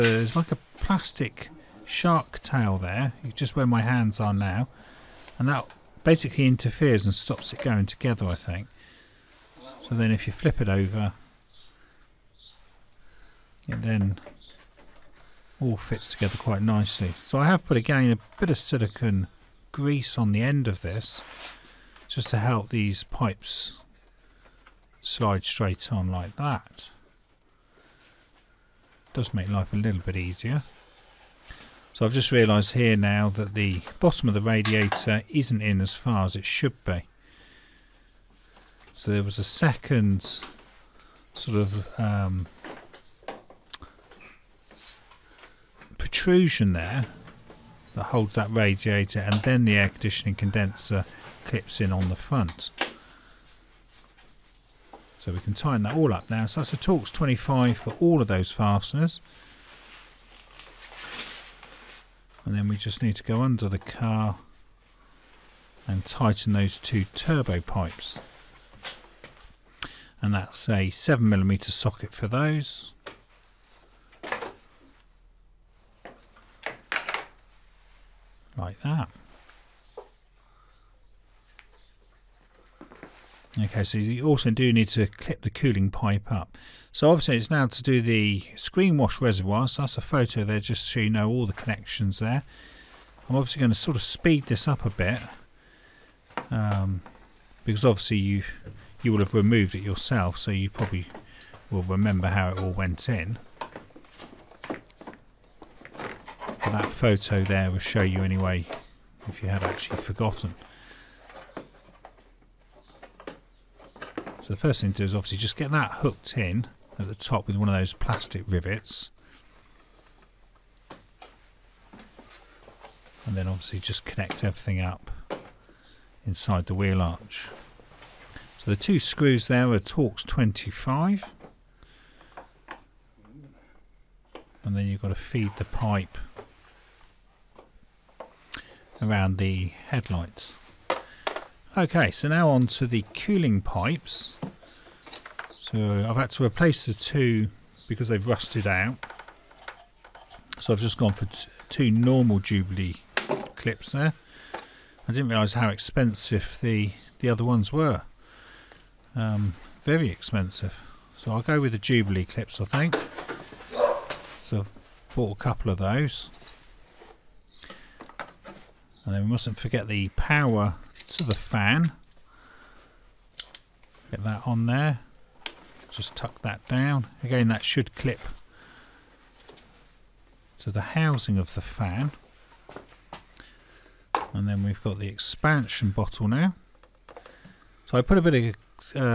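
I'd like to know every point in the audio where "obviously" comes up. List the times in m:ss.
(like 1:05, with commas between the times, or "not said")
1:27, 1:33, 1:37, 1:55, 2:03.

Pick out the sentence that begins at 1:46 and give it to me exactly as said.
that photo there will show you anyway if you had actually forgotten.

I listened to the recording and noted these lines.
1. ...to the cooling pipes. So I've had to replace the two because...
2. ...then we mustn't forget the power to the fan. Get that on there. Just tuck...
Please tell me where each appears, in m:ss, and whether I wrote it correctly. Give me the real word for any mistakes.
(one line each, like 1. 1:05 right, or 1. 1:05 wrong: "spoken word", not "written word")
1. 2:22 right
2. 2:49 right.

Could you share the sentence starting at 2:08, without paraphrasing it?
So the two screws there are Torx 25.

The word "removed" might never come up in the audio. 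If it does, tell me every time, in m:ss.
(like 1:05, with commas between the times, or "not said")
1:39.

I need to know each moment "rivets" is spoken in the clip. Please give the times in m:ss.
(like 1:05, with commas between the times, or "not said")
1:58.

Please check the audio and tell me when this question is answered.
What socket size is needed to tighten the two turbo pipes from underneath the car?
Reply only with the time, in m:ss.
1:10.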